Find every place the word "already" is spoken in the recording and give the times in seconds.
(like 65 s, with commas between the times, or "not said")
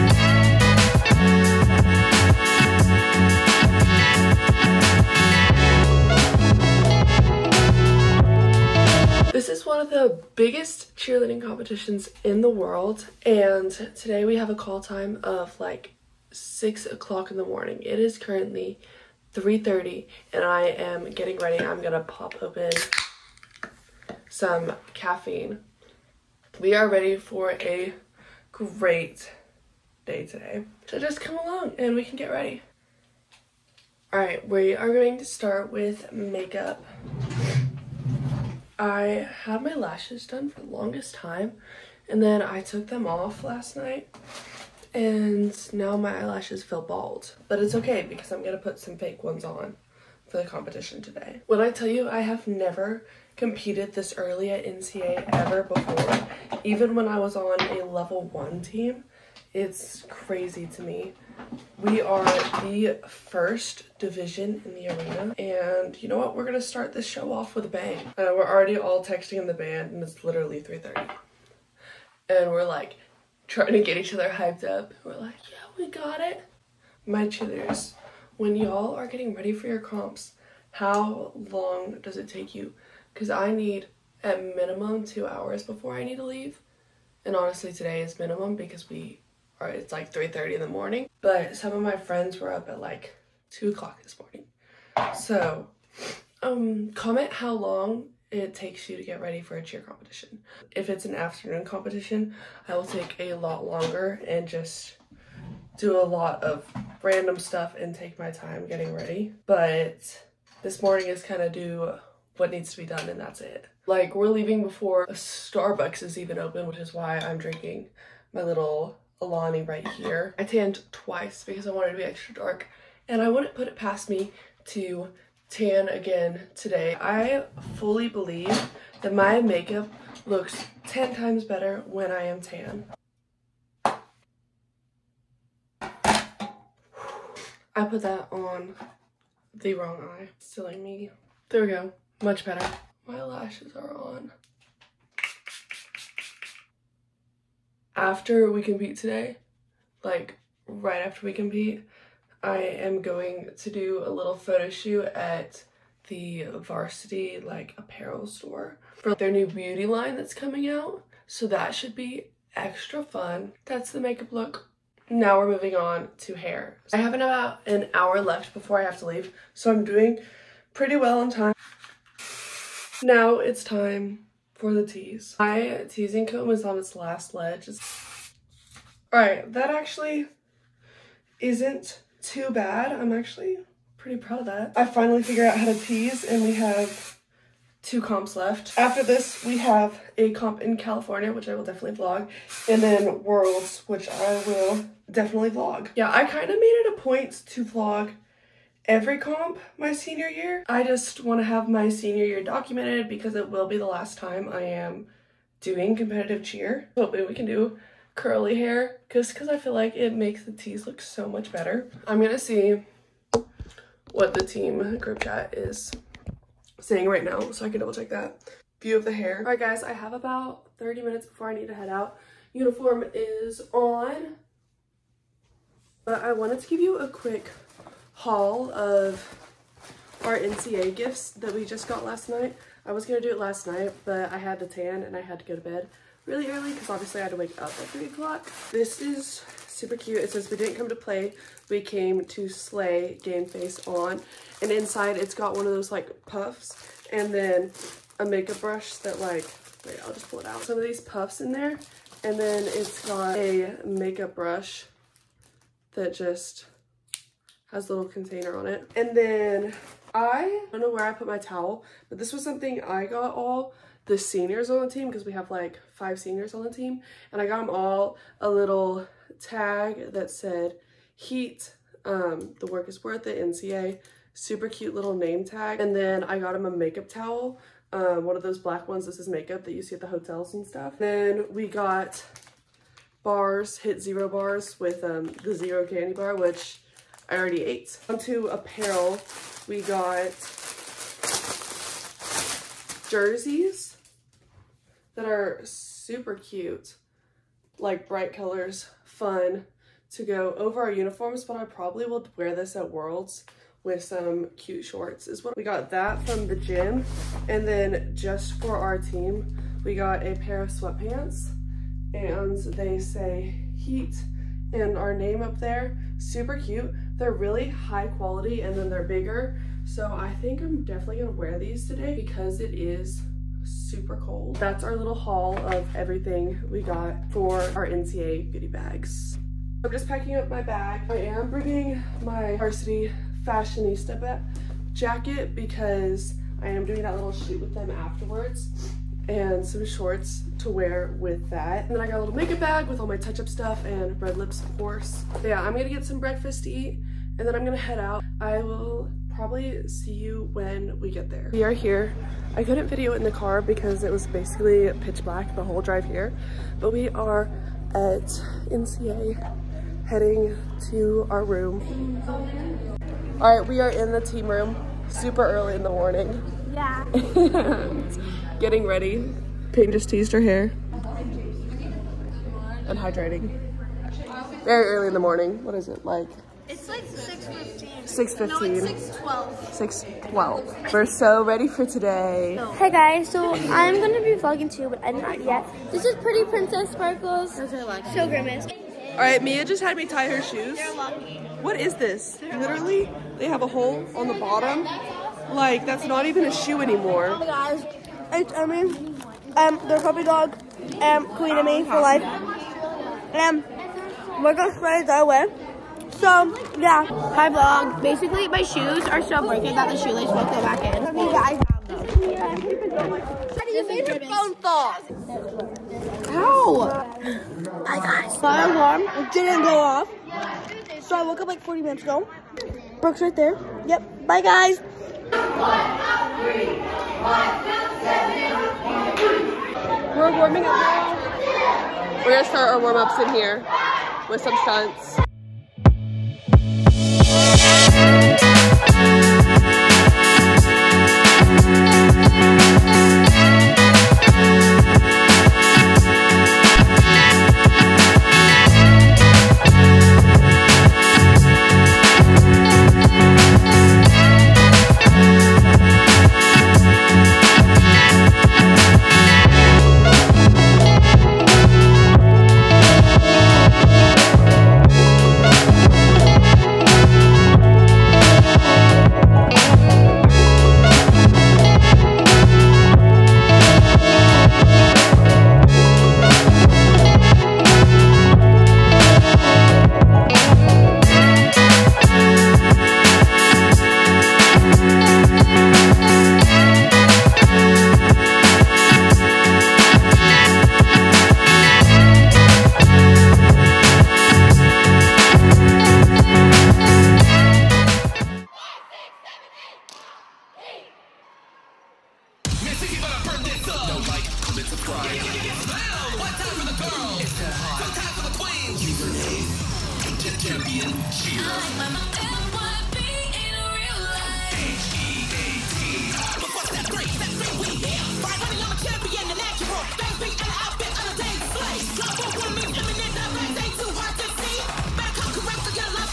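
68 s, 287 s.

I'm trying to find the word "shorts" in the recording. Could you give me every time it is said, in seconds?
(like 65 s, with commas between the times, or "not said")
304 s, 339 s.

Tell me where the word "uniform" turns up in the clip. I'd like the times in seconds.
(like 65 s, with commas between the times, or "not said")
222 s, 300 s.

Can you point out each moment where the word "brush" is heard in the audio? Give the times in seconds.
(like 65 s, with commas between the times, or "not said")
248 s, 254 s.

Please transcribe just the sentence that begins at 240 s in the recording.
It says, we didn't come to play, we came to slay game face on.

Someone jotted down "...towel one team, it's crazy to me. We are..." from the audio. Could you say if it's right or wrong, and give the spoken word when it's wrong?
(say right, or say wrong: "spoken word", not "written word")
wrong: "level", not "towel".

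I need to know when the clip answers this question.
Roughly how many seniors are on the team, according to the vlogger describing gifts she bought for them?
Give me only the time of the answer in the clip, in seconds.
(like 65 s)
265 s.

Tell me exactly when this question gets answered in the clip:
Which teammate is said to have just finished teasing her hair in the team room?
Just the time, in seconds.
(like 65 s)
369 s.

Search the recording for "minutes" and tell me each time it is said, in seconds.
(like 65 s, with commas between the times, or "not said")
221 s, 421 s.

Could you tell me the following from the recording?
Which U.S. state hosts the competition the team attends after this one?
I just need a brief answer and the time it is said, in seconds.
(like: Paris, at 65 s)
California, at 190 s.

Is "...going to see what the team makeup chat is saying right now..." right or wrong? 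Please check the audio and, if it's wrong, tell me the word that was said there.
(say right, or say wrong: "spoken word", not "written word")
wrong: "group", not "makeup".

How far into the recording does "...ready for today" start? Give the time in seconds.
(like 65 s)
381 s.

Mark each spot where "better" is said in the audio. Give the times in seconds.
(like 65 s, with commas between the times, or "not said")
131 s, 142 s, 211 s.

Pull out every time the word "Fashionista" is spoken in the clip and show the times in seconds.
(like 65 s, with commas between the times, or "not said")
333 s.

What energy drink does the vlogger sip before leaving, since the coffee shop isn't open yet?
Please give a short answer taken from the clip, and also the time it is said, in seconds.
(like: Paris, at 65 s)
Alani, at 119 s.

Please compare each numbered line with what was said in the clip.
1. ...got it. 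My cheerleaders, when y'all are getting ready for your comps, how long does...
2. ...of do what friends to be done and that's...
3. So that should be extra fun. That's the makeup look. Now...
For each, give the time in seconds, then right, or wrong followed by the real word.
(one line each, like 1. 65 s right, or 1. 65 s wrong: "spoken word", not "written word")
1. 75 s right
2. 111 s wrong: "needs", not "friends"
3. 161 s right.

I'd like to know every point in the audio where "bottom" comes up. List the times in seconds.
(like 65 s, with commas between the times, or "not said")
394 s.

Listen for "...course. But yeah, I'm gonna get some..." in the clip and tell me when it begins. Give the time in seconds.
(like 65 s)
344 s.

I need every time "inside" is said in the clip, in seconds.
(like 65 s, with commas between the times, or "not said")
244 s.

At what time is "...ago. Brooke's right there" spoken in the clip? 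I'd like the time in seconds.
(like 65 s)
422 s.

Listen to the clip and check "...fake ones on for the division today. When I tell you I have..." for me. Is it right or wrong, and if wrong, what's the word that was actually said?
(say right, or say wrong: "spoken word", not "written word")
wrong: "competition", not "division".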